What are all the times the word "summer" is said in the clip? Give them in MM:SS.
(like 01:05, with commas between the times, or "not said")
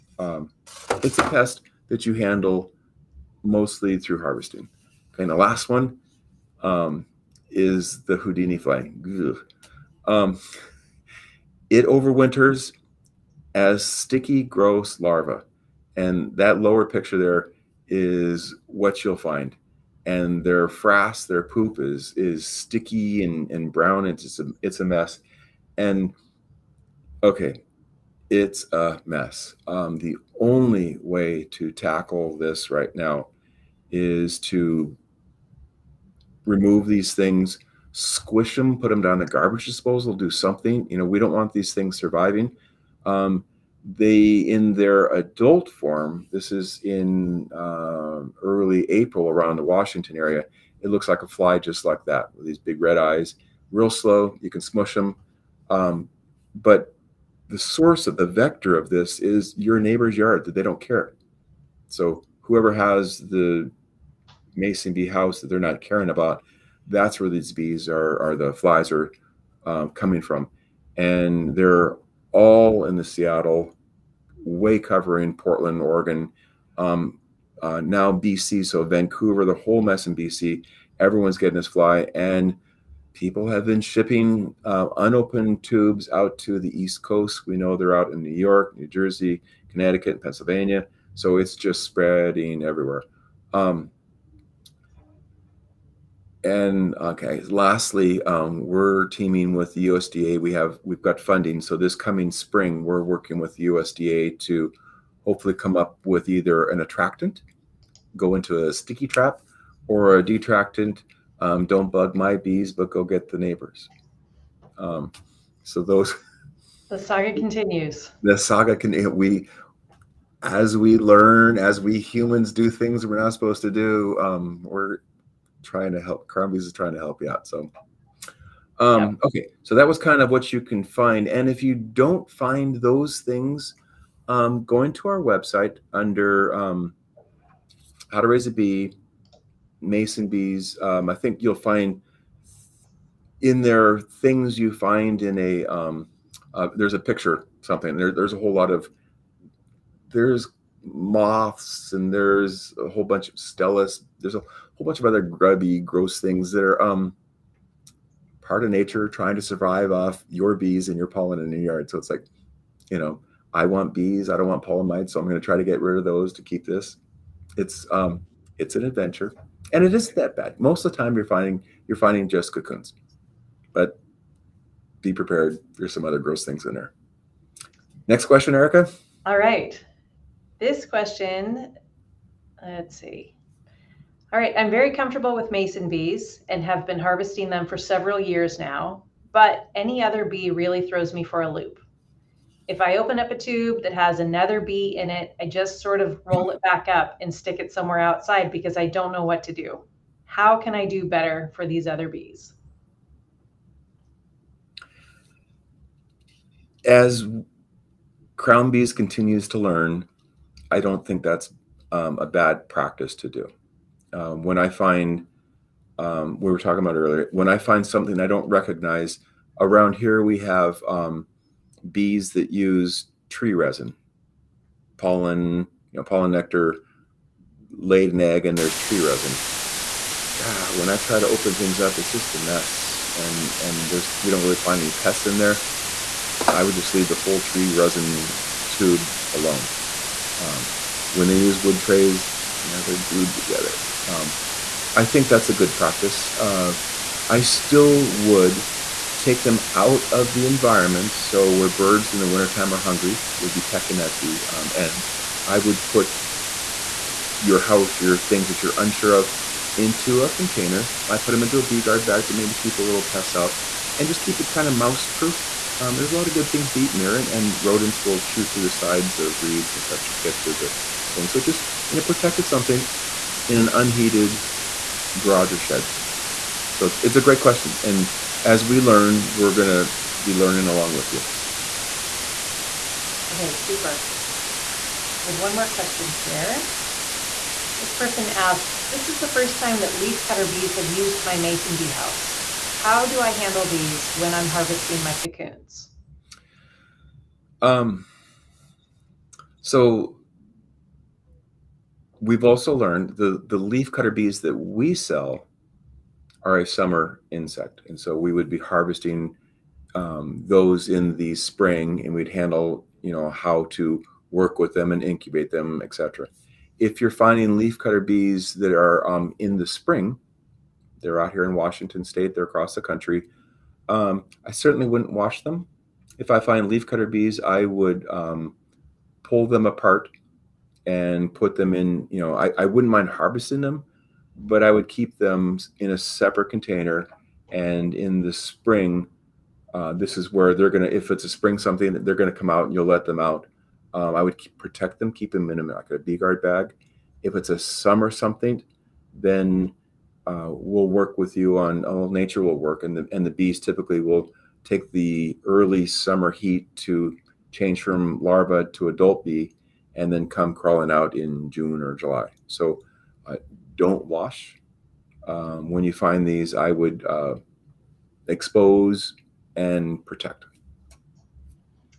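05:06, 05:47, 05:55.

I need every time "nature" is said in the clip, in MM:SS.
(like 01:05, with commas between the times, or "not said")
02:38, 05:52.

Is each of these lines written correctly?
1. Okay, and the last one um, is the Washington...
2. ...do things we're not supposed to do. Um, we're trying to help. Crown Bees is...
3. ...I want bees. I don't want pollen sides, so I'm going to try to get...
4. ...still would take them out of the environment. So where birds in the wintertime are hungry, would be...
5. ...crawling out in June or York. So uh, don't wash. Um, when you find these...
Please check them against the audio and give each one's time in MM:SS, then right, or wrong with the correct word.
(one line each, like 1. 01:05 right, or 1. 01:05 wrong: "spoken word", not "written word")
1. 00:05 wrong: "Houdini", not "Washington"
2. 02:02 right
3. 02:43 wrong: "mites", not "sides"
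4. 04:07 right
5. 06:00 wrong: "July", not "York".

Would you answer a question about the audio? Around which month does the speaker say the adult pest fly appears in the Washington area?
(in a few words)
April.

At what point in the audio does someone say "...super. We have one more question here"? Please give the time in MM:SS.
04:43.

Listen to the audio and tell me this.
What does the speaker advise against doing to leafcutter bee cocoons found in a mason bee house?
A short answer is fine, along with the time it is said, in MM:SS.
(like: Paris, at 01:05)
Wash them, at 05:24.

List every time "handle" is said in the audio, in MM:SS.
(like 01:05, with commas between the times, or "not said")
00:02, 04:53, 05:12.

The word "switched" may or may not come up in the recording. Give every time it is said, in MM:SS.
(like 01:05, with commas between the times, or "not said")
not said.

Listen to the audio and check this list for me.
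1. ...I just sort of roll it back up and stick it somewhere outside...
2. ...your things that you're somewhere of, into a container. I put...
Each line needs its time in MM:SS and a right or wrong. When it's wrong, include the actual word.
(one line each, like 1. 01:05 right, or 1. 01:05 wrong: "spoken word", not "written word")
1. 03:15 right
2. 04:18 wrong: "unsure", not "somewhere".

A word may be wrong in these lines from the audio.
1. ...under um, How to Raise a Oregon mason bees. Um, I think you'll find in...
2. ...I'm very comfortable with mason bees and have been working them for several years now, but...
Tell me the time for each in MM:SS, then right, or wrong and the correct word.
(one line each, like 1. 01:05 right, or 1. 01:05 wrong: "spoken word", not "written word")
1. 02:15 wrong: "Bee", not "Oregon"
2. 03:04 wrong: "harvesting", not "working".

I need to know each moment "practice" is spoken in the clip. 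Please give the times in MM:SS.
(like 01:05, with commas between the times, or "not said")
03:32, 04:05.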